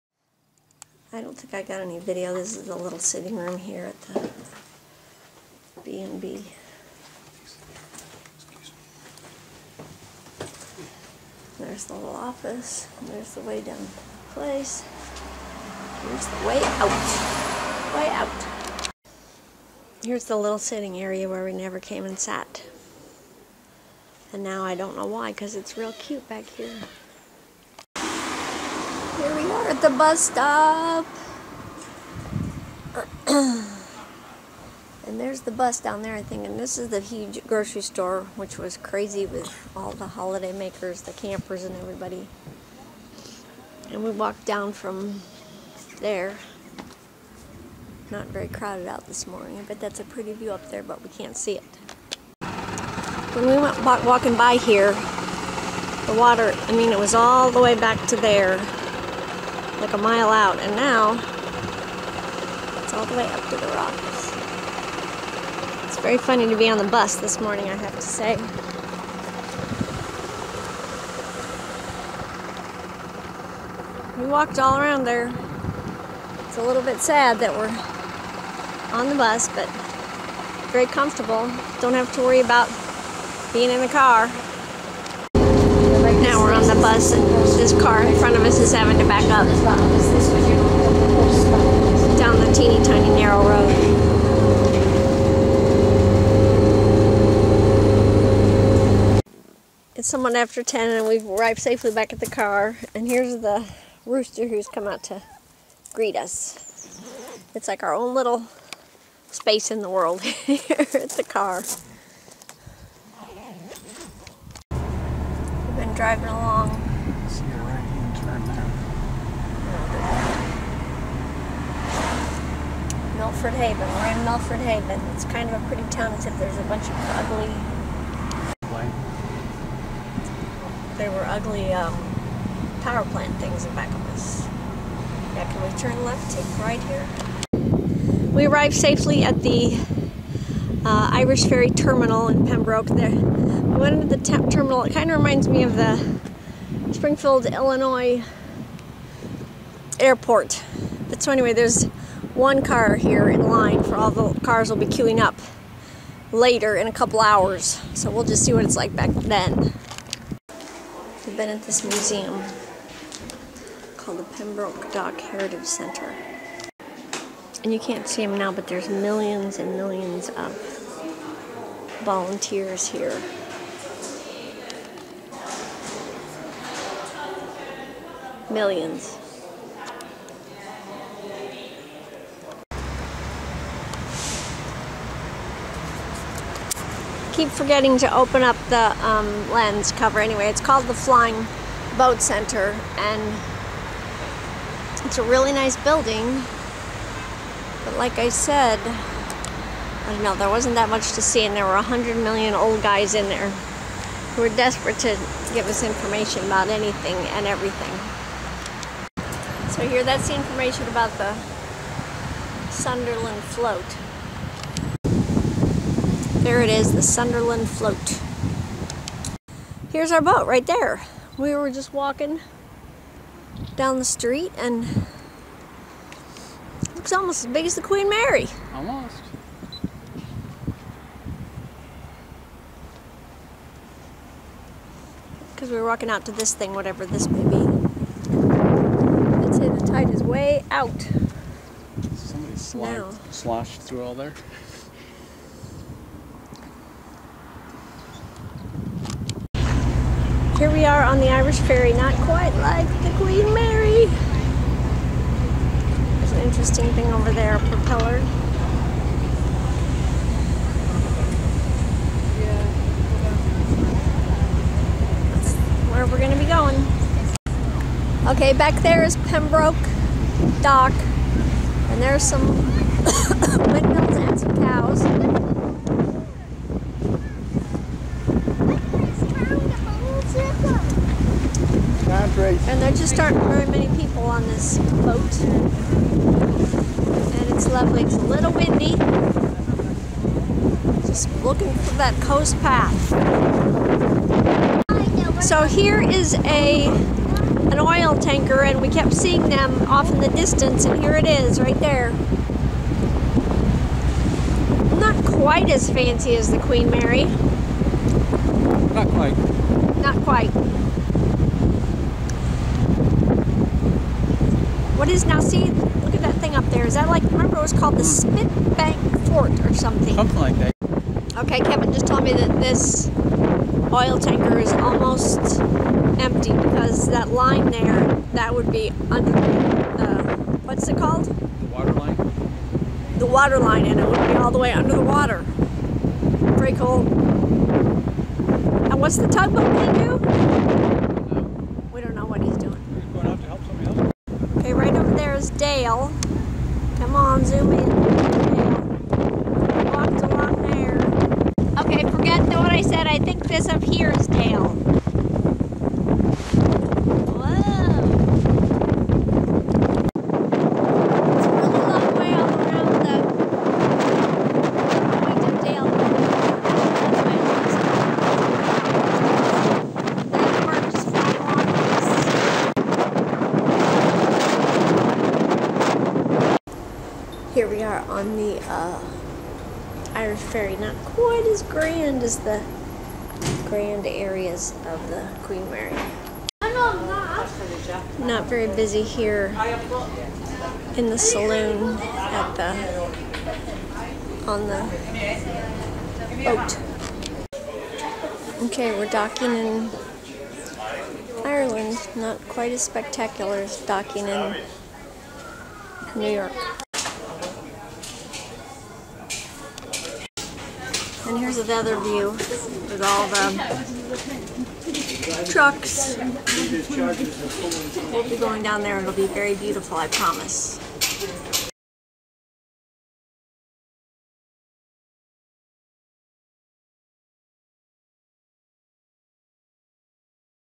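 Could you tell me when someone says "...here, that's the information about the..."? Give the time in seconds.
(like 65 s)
209 s.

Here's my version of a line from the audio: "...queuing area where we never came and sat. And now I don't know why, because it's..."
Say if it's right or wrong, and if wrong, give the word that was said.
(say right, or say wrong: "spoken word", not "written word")
wrong: "sitting", not "queuing".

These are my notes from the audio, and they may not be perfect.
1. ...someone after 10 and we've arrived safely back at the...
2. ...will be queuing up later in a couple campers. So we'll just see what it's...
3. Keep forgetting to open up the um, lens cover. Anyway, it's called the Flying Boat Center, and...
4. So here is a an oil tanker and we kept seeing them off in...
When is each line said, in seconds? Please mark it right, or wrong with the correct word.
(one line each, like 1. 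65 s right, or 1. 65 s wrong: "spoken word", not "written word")
1. 100 s right
2. 154 s wrong: "hours", not "campers"
3. 187 s right
4. 295 s right.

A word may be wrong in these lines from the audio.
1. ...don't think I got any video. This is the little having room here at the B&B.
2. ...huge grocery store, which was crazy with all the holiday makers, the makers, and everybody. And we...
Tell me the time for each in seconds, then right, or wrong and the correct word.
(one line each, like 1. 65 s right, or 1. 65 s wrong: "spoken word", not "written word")
1. 1 s wrong: "sitting", not "having"
2. 37 s wrong: "campers", not "makers".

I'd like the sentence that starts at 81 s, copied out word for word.
Don't have to worry about being in the car.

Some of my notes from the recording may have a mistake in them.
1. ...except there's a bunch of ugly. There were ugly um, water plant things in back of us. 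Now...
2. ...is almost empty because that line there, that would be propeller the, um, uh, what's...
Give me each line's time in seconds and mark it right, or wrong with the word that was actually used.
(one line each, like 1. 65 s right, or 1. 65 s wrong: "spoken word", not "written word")
1. 126 s wrong: "power", not "water"
2. 324 s wrong: "under", not "propeller".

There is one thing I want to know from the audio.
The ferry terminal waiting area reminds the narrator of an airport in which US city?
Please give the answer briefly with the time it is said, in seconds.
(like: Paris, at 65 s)
Springfield, Illinois, at 146 s.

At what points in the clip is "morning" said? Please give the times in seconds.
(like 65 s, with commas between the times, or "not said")
49 s, 67 s.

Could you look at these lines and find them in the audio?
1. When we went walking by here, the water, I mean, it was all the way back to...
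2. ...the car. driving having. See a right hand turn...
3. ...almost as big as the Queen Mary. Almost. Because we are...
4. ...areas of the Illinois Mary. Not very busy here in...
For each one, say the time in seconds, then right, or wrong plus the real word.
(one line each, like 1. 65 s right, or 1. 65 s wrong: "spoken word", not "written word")
1. 53 s right
2. 111 s wrong: "along", not "having"
3. 227 s right
4. 384 s wrong: "Queen", not "Illinois".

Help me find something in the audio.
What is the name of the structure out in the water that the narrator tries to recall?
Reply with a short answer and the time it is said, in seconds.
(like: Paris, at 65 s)
Spitbank Fort, at 318 s.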